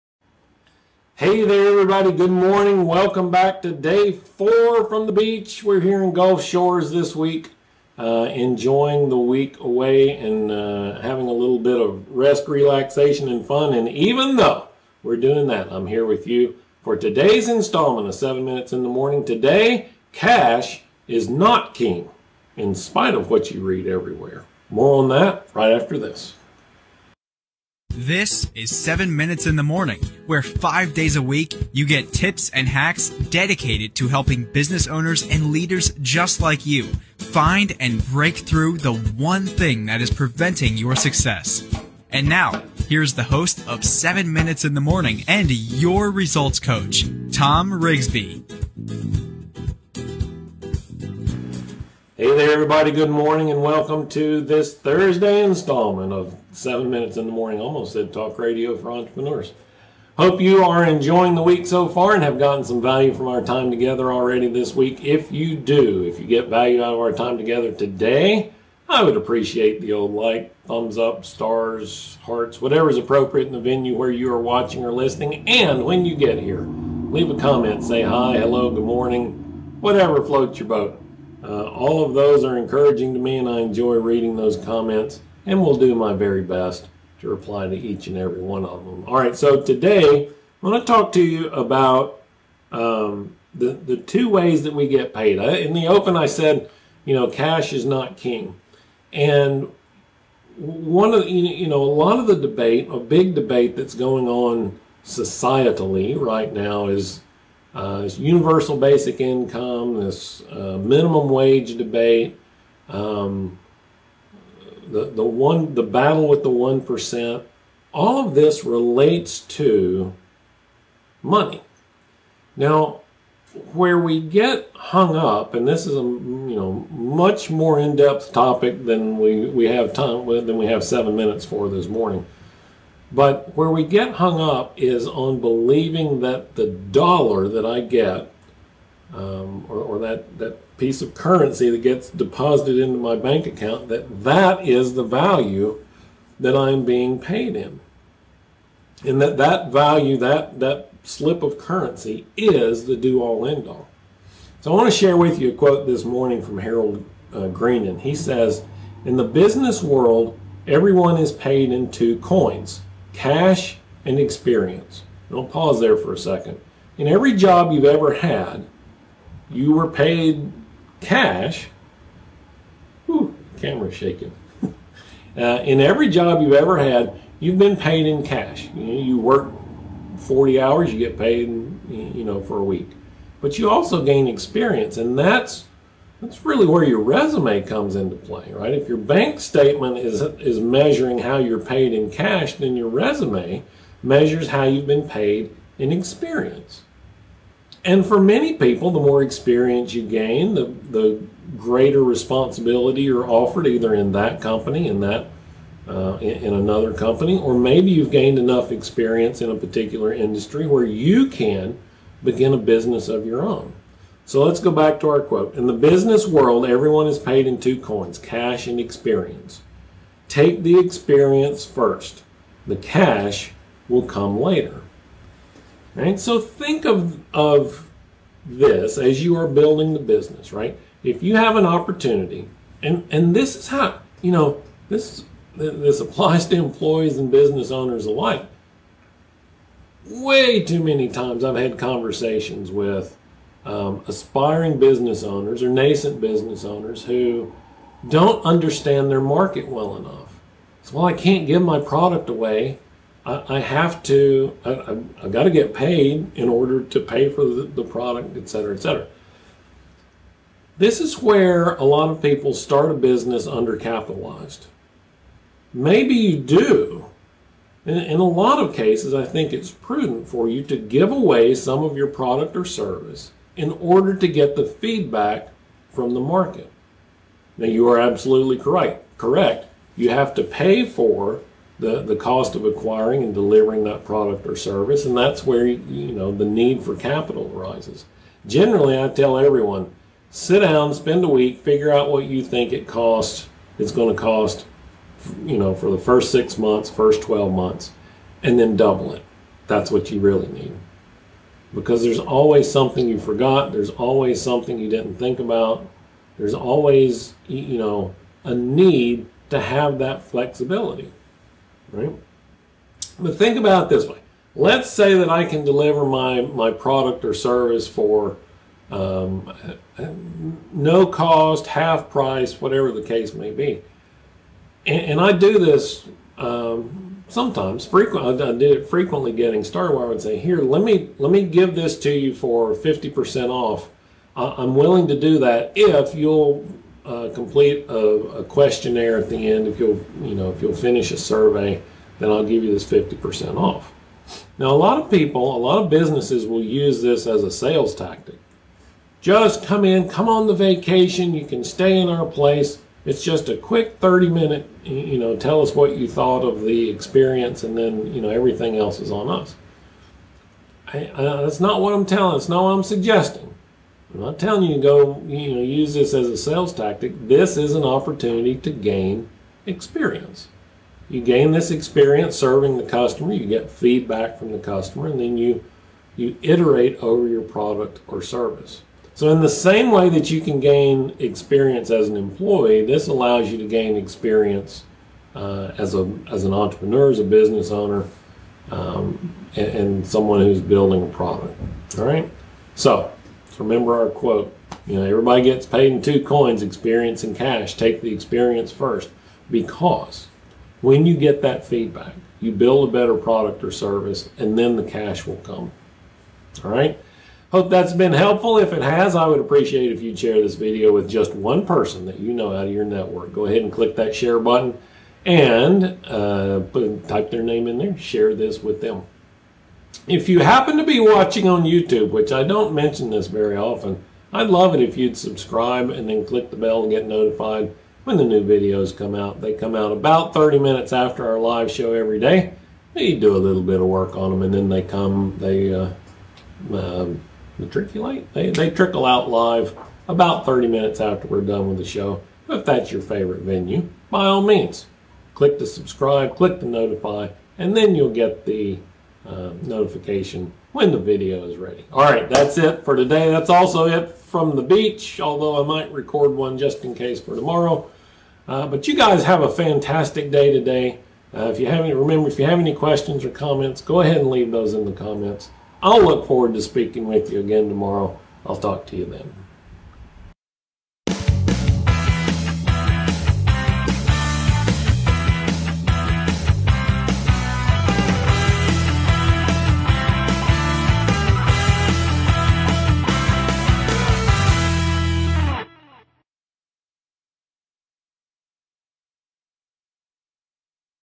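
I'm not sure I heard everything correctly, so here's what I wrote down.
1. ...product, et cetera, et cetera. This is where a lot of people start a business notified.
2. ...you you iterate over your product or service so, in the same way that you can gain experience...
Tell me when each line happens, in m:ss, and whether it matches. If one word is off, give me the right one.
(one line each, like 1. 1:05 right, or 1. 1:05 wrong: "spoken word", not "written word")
1. 4:17 wrong: "undercapitalized", not "notified"
2. 6:15 right.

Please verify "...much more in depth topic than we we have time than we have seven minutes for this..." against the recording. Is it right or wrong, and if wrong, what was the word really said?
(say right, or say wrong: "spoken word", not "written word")
right.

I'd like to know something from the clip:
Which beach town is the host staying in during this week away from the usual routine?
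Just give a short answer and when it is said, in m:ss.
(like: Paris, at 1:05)
Gulf Shores, at 0:06.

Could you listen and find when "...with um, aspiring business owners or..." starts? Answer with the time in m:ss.
4:02.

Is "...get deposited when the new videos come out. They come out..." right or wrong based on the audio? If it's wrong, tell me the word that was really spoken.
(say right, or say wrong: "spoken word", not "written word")
wrong: "notified", not "deposited".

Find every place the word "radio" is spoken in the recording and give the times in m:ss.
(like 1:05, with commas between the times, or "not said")
0:58.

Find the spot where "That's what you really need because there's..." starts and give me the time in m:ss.
4:59.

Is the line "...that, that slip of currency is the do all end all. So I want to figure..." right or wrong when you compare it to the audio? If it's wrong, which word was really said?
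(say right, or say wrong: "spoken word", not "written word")
wrong: "share", not "figure".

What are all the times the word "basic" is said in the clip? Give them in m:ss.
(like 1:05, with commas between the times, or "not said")
1:48.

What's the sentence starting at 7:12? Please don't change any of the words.
We do a little bit of work on them and then they come, they uh, uh, the Tricky Light.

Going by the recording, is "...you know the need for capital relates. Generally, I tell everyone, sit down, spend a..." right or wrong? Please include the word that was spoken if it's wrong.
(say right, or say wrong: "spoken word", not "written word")
wrong: "arises", not "relates".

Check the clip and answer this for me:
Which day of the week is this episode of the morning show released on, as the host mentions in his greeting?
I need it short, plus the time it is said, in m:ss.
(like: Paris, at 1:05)
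Thursday, at 0:54.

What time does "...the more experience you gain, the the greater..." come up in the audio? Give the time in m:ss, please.
3:18.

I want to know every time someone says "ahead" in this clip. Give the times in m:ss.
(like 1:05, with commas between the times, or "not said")
6:53, 7:44.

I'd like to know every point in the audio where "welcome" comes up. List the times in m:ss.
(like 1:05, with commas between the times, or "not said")
0:02, 0:53.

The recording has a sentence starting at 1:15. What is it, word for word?
And when you get here, leave a comment, say hi, hello, good morning, whatever floats your boat.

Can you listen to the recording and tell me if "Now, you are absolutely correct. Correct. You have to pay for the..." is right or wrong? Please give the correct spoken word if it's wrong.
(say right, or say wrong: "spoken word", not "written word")
right.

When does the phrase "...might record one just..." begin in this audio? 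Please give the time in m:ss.
7:35.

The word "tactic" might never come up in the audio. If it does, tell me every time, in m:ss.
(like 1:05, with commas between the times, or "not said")
5:47, 6:06.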